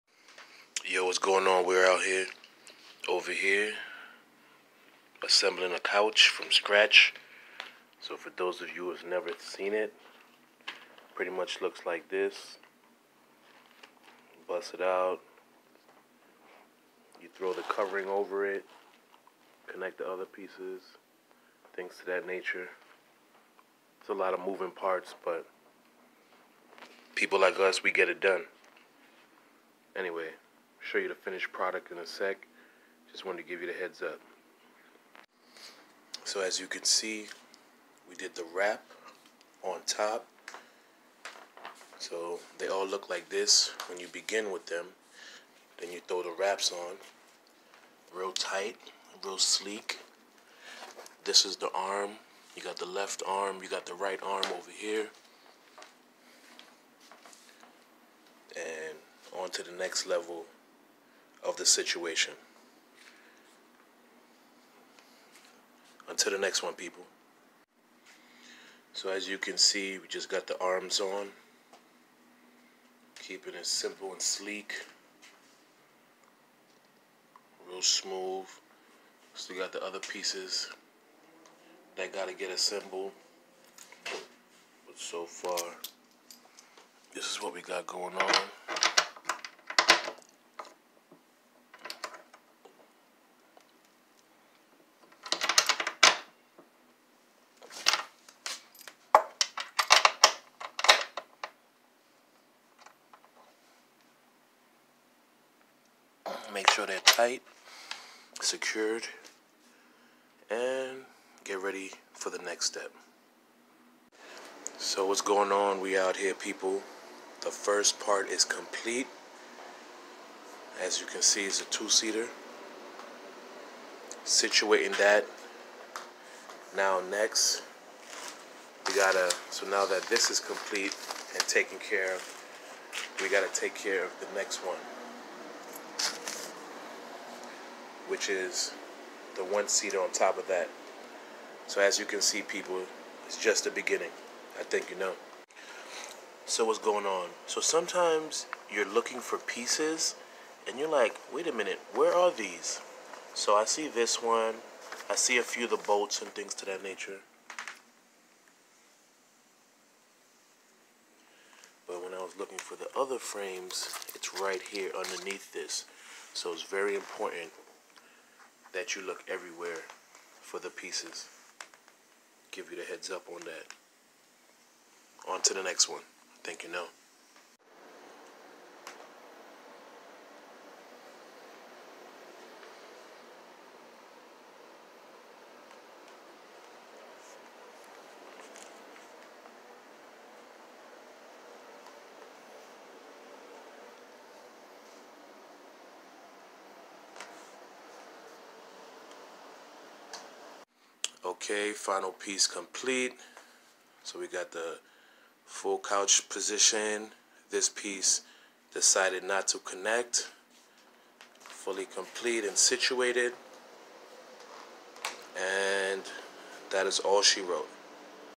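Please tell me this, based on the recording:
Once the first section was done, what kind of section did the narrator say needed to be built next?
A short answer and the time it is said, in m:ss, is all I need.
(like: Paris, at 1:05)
one seater, at 2:19.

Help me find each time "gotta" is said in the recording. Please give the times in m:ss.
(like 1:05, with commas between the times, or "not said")
1:22, 2:08, 2:13.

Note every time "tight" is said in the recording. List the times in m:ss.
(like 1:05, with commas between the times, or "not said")
0:48, 1:46.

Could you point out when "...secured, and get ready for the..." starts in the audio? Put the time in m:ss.
1:48.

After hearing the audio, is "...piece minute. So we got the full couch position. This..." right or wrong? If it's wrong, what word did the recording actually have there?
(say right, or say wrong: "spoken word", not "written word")
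wrong: "complete", not "minute".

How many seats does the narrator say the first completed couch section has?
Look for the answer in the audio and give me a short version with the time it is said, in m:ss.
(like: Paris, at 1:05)
two-seater, at 2:01.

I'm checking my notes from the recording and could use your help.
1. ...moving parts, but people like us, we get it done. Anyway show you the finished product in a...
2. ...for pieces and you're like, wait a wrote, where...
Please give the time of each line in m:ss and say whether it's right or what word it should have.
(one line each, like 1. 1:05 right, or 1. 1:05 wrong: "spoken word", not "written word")
1. 0:24 right
2. 2:29 wrong: "minute", not "wrote".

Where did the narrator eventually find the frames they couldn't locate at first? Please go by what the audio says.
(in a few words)
underneath this.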